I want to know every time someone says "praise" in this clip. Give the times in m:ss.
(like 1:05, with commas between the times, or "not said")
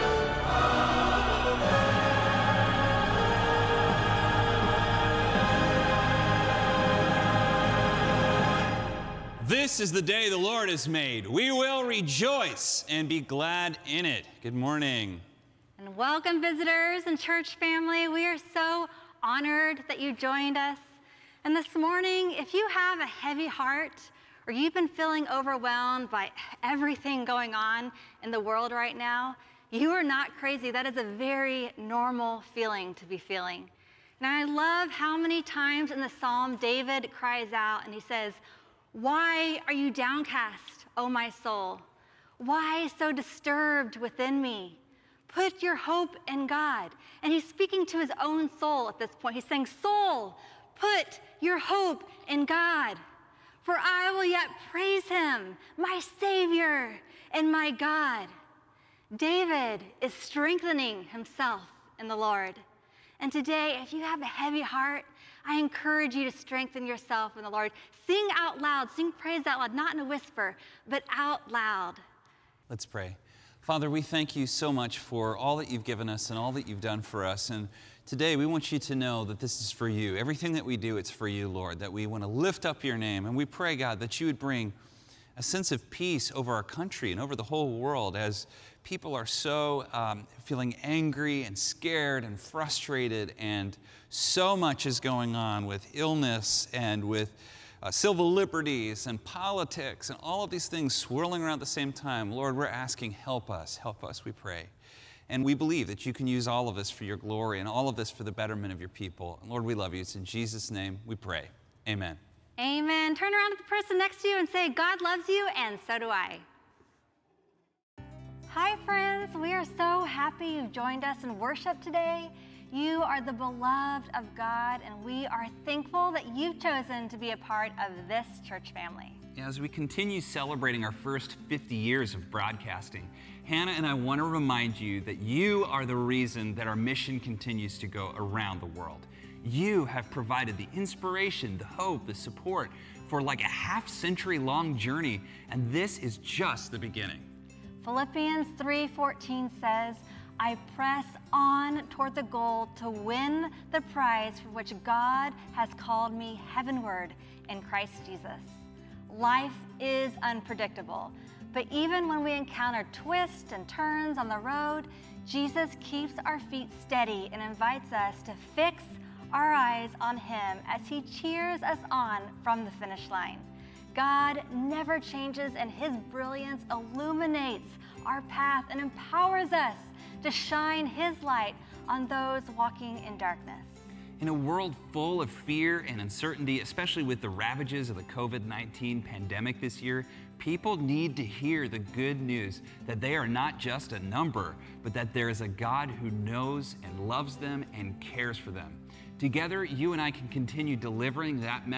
0:54, 1:09.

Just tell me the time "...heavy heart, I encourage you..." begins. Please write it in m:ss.
1:04.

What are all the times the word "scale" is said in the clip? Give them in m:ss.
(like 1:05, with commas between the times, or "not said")
not said.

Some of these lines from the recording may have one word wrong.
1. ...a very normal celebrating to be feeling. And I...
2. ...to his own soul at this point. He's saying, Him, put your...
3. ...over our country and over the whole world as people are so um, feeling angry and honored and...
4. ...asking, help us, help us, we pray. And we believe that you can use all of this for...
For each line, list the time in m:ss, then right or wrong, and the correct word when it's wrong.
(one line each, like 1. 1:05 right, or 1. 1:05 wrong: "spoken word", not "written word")
1. 0:30 wrong: "feeling", not "celebrating"
2. 0:47 wrong: "Soul", not "Him"
3. 1:26 wrong: "scared", not "honored"
4. 1:42 right.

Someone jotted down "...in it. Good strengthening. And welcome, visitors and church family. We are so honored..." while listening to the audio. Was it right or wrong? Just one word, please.
wrong.